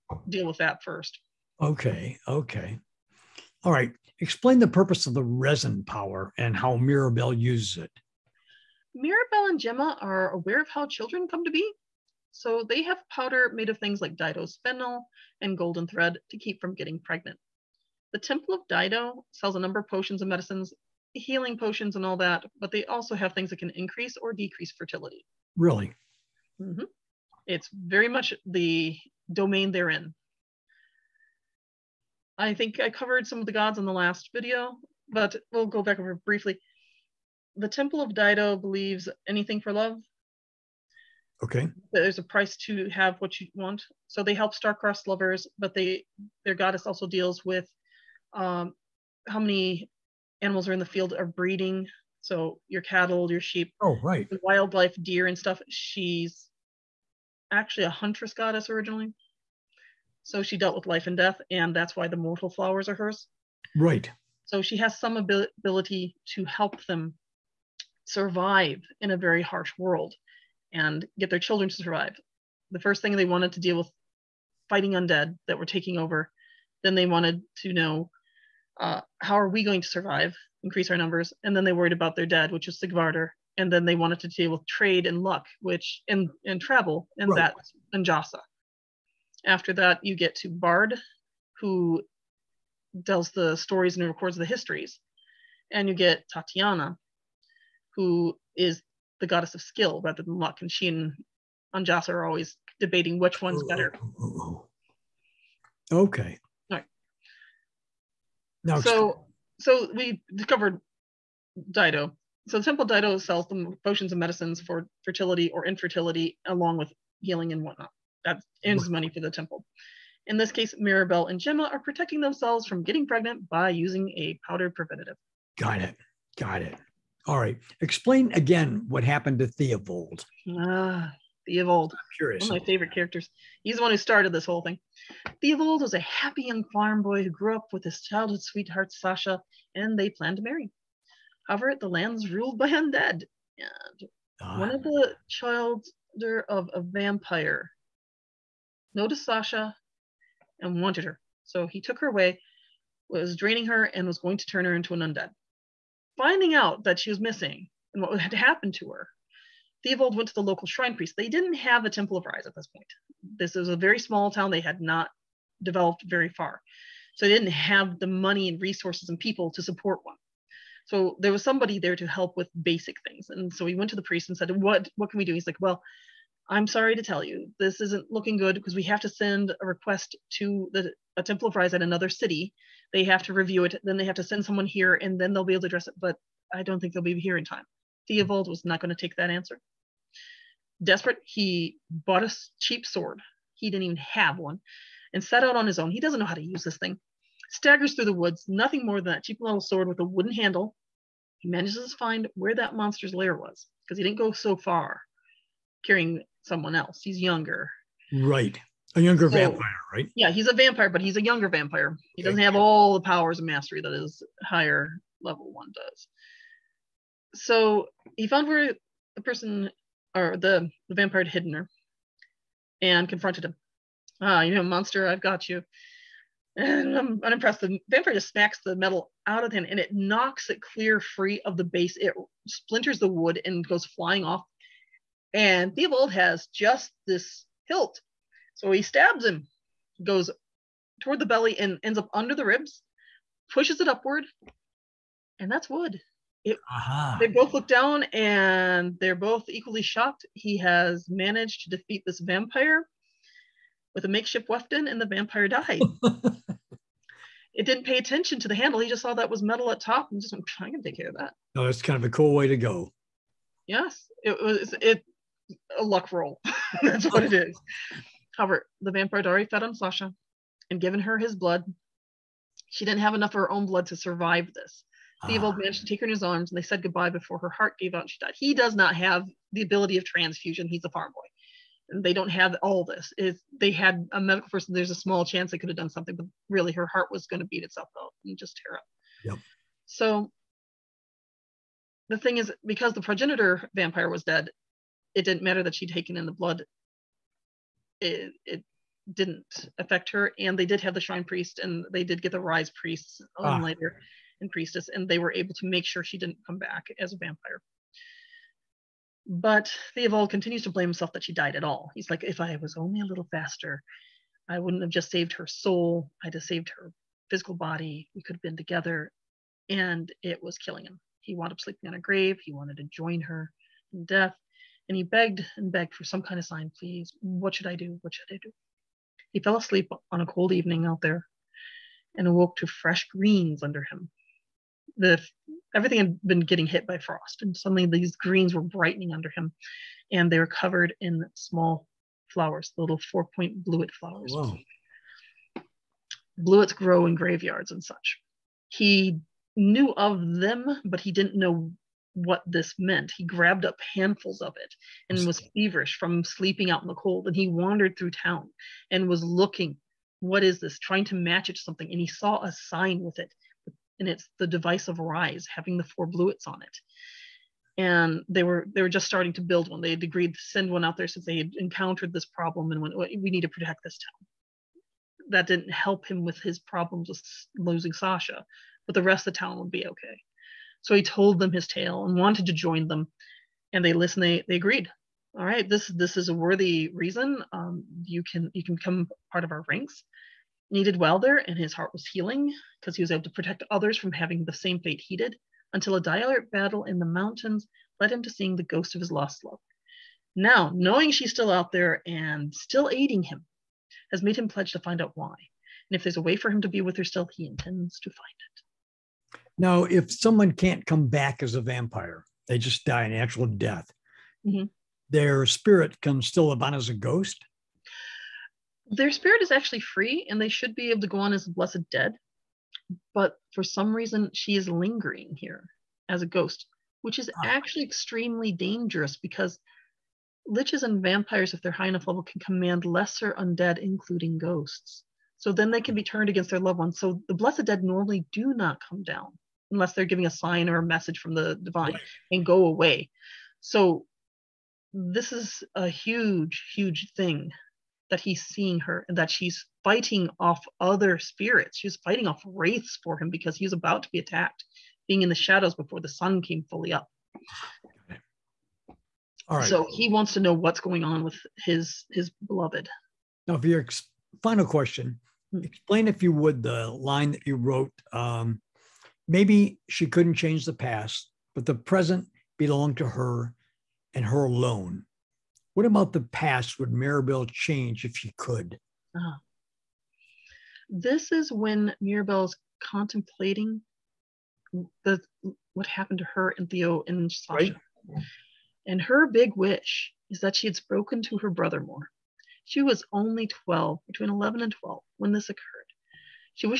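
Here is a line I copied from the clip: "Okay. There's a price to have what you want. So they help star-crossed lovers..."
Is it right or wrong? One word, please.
right.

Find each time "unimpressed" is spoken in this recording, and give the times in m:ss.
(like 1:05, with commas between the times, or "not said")
3:47.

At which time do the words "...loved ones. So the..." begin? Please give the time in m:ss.
7:16.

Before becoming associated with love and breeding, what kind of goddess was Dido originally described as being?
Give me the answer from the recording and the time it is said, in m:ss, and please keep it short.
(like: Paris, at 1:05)
a huntress goddess, at 0:57.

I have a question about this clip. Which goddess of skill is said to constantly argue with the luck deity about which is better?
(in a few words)
Tatiana.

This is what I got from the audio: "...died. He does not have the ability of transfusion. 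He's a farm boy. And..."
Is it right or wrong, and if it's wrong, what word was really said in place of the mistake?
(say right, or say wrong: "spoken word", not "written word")
right.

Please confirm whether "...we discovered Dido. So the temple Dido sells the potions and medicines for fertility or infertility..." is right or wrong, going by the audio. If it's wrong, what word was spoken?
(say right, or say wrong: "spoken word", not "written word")
right.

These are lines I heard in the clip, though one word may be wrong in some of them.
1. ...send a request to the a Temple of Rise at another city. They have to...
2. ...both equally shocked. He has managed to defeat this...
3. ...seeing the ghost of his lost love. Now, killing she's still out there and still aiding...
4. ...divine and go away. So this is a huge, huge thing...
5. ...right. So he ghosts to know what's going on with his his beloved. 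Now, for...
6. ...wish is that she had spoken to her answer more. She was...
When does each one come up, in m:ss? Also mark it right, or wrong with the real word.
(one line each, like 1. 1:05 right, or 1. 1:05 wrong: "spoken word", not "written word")
1. 2:59 right
2. 4:09 right
3. 6:38 wrong: "knowing", not "killing"
4. 7:21 right
5. 7:39 wrong: "wants", not "ghosts"
6. 8:09 wrong: "brother", not "answer".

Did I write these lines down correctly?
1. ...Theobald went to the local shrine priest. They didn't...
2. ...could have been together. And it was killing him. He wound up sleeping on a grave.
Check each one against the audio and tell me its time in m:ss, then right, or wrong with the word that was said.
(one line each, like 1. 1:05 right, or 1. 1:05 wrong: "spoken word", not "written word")
1. 2:39 right
2. 5:18 right.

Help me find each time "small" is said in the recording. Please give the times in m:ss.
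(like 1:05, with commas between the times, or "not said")
2:43, 4:44, 5:41.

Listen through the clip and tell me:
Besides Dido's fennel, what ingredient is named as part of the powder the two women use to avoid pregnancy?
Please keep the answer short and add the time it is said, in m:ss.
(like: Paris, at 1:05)
golden thread, at 0:15.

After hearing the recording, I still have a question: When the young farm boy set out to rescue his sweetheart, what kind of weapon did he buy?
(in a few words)
a cheap sword.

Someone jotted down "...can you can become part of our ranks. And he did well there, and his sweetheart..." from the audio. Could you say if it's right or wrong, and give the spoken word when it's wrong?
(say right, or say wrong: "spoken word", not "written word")
wrong: "heart", not "sweetheart".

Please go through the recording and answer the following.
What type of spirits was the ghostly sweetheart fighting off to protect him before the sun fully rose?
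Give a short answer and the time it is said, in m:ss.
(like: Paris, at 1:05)
wraiths, at 7:32.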